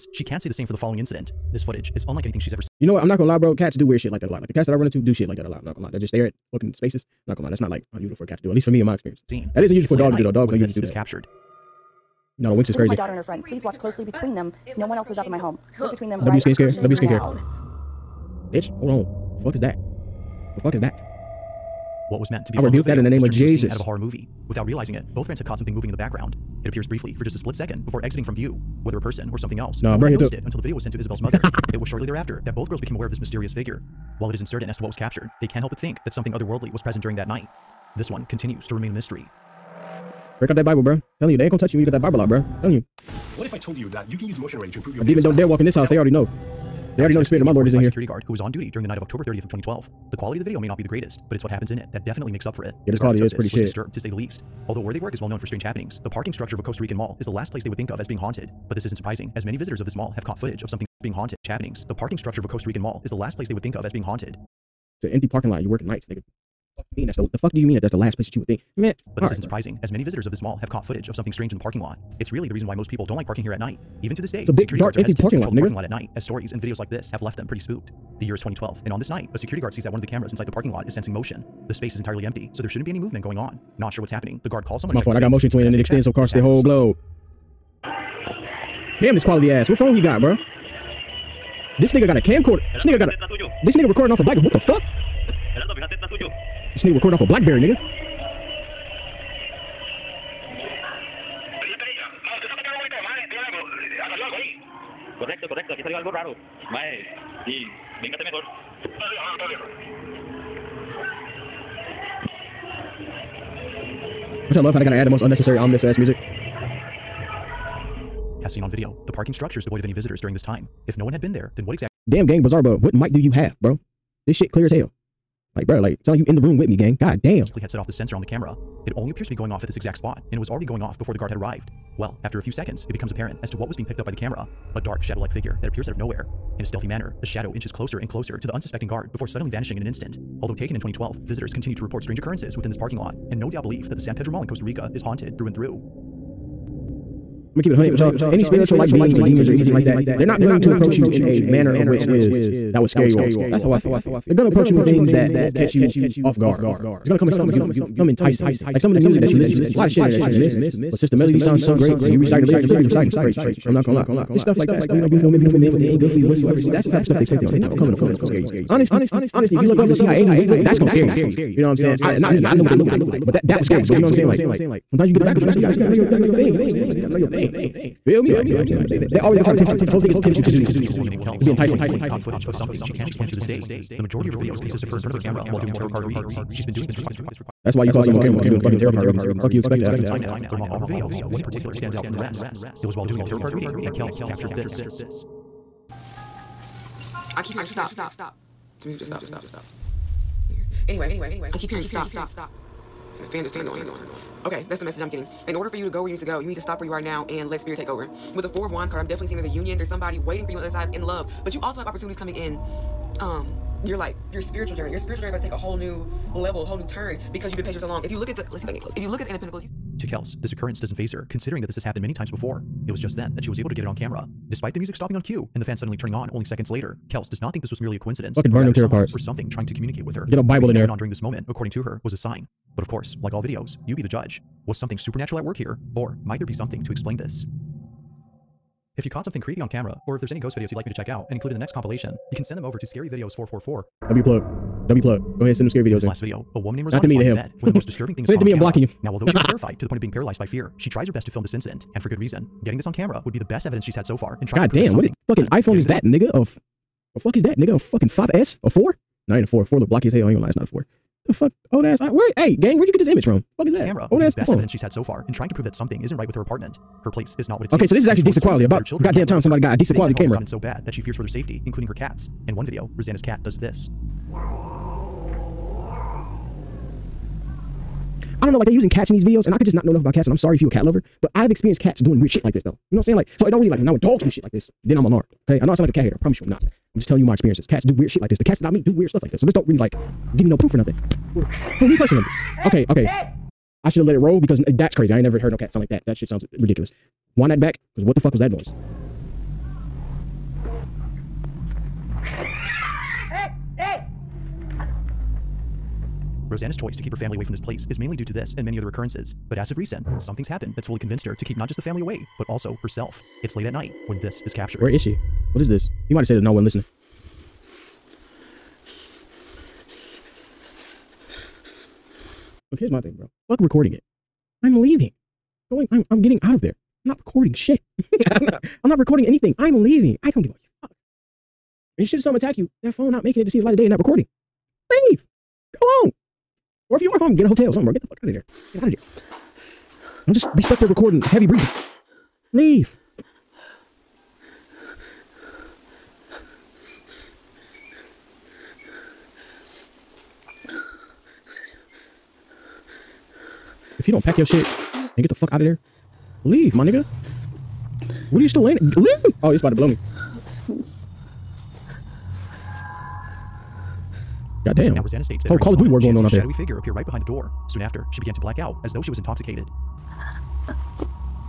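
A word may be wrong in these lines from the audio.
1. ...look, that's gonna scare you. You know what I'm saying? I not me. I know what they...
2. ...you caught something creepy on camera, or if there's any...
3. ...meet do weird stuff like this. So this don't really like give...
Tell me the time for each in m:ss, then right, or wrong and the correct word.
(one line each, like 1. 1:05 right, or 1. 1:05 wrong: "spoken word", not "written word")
1. 2:50 right
2. 3:59 right
3. 4:48 right.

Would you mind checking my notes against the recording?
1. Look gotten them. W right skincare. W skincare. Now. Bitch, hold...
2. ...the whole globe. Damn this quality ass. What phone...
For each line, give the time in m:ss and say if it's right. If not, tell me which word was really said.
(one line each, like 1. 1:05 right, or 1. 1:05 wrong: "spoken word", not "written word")
1. 0:15 wrong: "between", not "gotten"
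2. 1:26 right.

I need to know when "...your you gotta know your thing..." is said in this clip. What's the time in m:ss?
2:55.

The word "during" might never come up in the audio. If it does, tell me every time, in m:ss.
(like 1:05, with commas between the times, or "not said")
0:37, 0:48, 2:00, 3:50.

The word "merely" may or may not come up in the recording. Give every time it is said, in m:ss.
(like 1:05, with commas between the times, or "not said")
3:47.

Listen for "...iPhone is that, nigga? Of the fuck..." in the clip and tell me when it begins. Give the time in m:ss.
4:15.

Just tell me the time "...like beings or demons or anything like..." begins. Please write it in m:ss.
2:28.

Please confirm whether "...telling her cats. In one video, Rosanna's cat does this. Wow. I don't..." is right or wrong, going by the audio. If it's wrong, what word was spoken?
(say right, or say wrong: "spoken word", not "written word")
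wrong: "including", not "telling".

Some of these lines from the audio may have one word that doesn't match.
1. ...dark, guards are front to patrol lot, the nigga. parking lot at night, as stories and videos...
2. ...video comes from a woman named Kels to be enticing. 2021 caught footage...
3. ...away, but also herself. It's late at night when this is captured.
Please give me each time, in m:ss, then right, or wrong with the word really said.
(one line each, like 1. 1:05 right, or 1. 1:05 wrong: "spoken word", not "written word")
1. 1:14 wrong: "hesitant", not "front"
2. 3:00 wrong: "2020", not "2021"
3. 5:12 right.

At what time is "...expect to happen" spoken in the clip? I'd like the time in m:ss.
3:09.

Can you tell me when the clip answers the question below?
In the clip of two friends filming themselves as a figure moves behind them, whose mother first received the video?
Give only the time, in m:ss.
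0:30.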